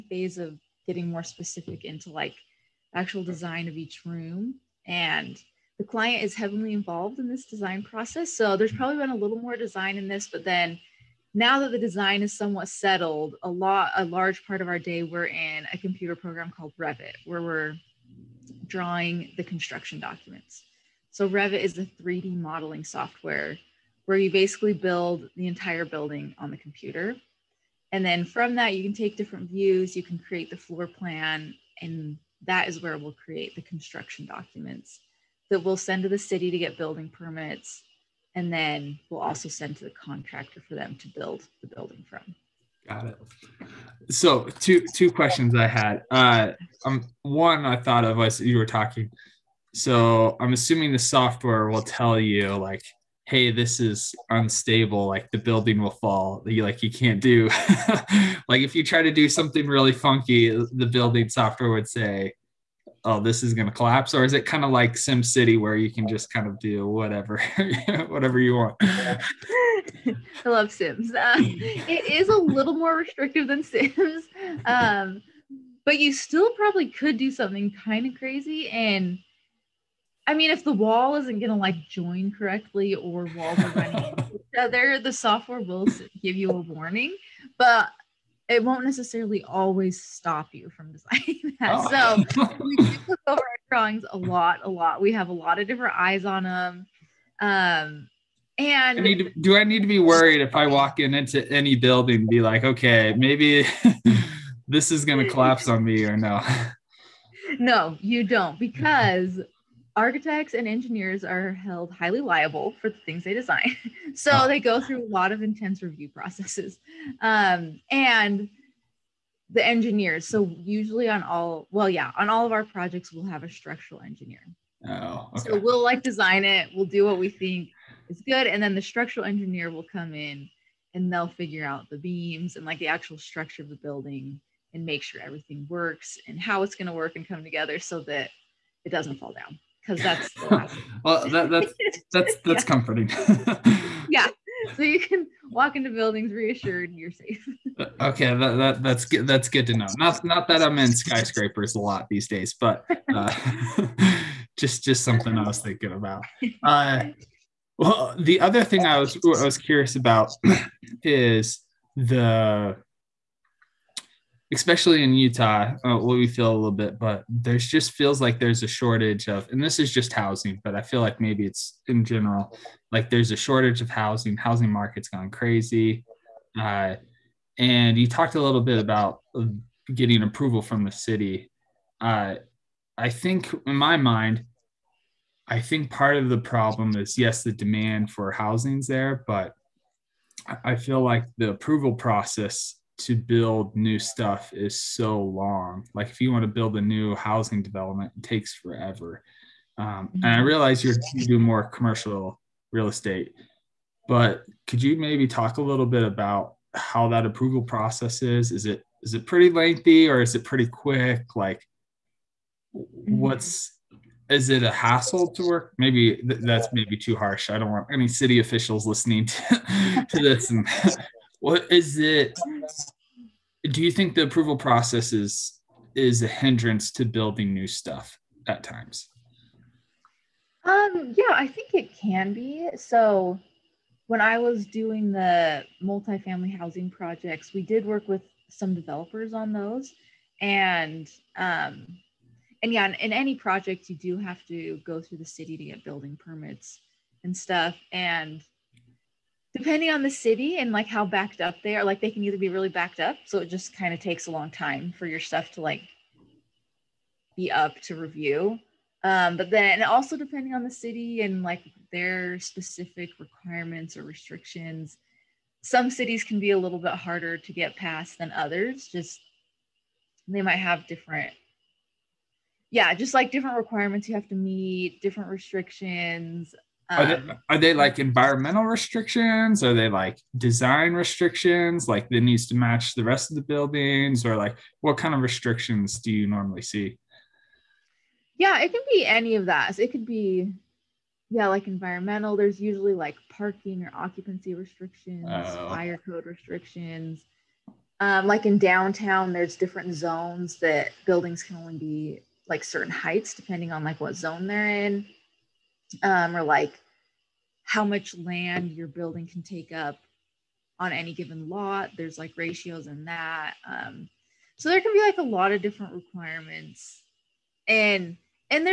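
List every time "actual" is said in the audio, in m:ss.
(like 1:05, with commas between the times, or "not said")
0:02, 2:12.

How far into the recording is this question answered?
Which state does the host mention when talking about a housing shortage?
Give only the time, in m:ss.
2:45.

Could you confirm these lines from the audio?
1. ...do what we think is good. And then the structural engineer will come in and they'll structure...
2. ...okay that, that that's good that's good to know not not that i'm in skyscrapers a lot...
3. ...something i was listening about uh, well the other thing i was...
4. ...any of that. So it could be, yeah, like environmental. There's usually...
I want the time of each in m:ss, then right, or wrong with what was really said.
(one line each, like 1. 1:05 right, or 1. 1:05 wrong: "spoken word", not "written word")
1. 2:06 wrong: "figure", not "structure"
2. 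2:28 right
3. 2:35 wrong: "thinking", not "listening"
4. 4:49 right.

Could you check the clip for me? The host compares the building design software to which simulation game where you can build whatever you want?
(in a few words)
SimCity.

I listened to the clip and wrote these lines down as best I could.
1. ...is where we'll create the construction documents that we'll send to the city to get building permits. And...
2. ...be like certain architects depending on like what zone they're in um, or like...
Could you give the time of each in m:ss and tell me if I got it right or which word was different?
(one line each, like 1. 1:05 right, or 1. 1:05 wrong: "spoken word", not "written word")
1. 0:32 right
2. 5:01 wrong: "heights", not "architects".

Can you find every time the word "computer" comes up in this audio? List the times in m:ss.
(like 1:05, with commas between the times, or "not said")
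0:15, 0:26.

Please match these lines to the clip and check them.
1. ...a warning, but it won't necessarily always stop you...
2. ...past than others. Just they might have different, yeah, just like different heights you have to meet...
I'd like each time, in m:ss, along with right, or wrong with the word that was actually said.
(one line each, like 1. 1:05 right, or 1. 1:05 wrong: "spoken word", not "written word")
1. 1:26 right
2. 4:27 wrong: "requirements", not "heights".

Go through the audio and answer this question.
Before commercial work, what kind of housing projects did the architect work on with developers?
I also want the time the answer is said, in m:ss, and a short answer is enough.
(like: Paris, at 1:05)
Multifamily housing, at 3:55.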